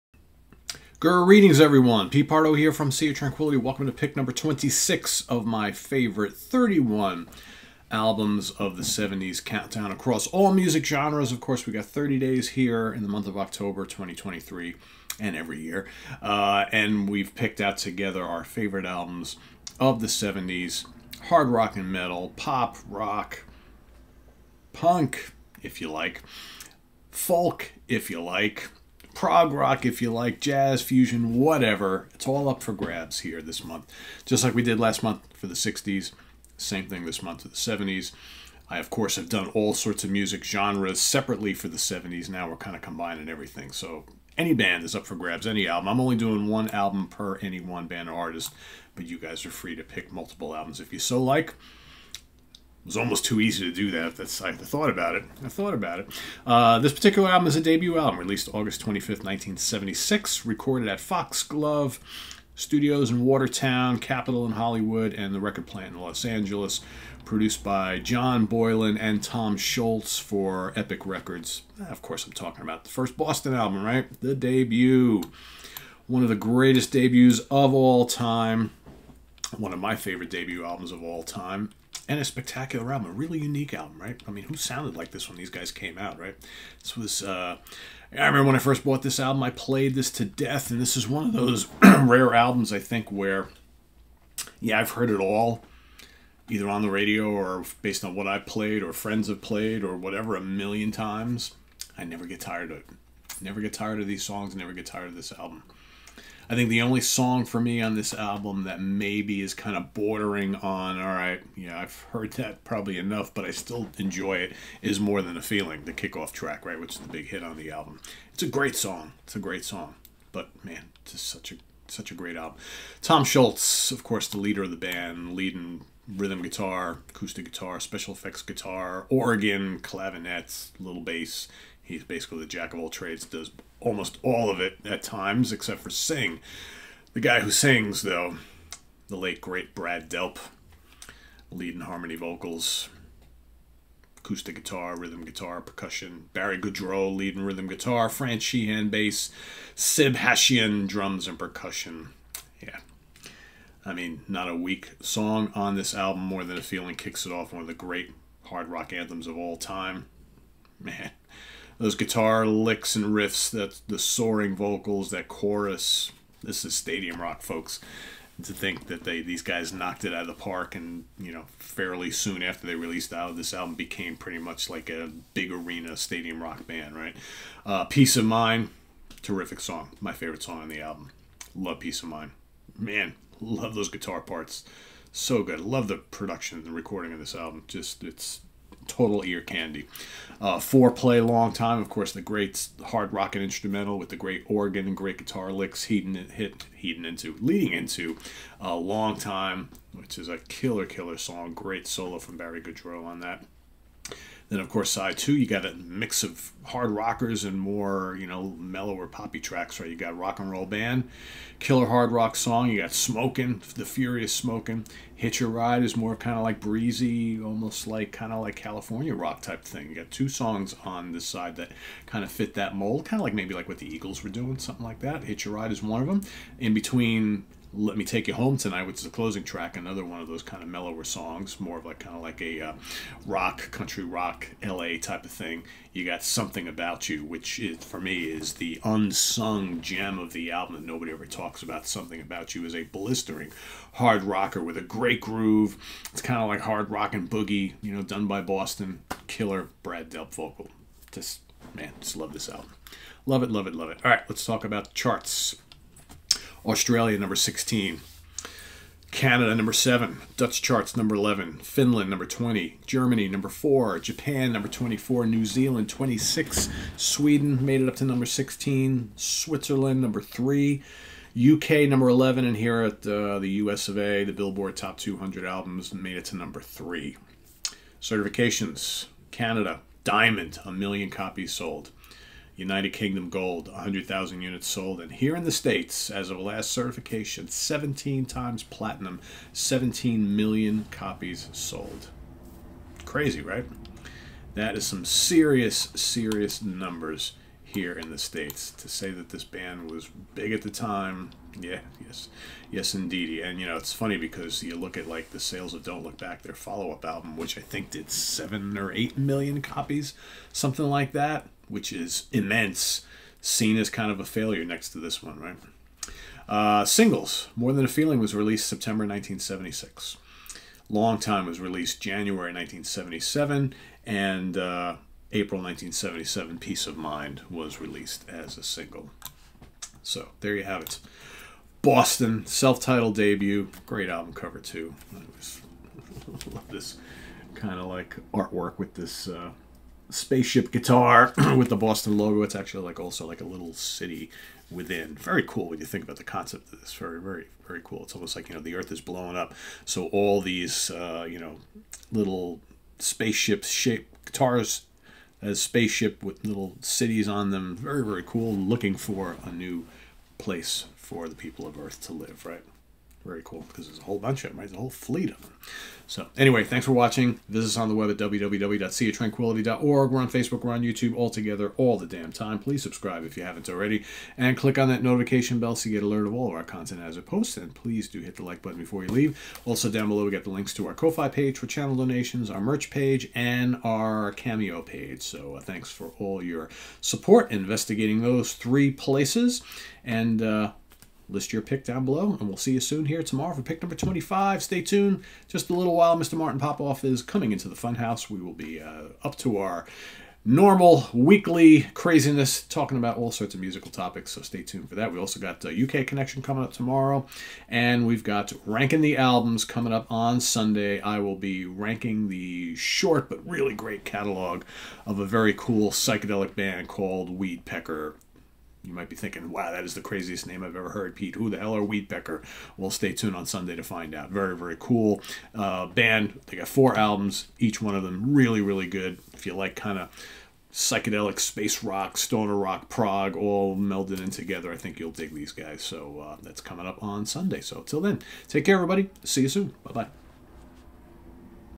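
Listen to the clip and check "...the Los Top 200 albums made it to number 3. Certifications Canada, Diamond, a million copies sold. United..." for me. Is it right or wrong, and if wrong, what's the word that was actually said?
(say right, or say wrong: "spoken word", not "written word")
wrong: "Billboard", not "Los".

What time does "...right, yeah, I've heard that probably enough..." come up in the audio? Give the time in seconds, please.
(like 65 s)
111 s.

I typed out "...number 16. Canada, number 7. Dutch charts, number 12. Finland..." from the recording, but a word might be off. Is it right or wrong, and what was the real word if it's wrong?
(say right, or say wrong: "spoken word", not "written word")
wrong: "11", not "12".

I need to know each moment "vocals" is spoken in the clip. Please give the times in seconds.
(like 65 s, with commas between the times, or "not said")
142 s, 164 s, 250 s.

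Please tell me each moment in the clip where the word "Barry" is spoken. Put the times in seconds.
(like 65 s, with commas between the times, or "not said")
146 s, 202 s.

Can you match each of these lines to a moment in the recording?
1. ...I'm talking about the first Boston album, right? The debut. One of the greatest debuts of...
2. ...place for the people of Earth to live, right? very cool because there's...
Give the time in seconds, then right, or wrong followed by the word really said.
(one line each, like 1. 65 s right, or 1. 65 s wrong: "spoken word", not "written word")
1. 72 s right
2. 360 s right.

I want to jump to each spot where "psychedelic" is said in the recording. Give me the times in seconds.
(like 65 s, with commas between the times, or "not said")
415 s, 430 s.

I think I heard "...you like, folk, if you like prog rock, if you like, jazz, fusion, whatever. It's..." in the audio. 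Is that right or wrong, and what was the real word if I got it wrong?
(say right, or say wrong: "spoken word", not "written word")
right.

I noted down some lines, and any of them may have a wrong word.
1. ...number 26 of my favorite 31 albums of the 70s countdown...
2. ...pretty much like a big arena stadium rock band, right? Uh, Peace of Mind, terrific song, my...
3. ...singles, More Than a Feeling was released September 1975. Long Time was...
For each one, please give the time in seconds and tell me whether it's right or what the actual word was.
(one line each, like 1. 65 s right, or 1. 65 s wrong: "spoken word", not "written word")
1. 4 s right
2. 174 s right
3. 316 s wrong: "1976", not "1975".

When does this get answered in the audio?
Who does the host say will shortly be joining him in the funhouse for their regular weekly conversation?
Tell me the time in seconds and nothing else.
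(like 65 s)
396 s.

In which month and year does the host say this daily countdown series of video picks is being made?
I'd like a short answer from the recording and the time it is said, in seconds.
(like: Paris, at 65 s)
October 2023, at 13 s.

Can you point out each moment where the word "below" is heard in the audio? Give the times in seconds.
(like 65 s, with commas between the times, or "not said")
380 s, 392 s.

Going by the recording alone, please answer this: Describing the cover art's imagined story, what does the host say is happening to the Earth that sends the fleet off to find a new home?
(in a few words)
blowing up.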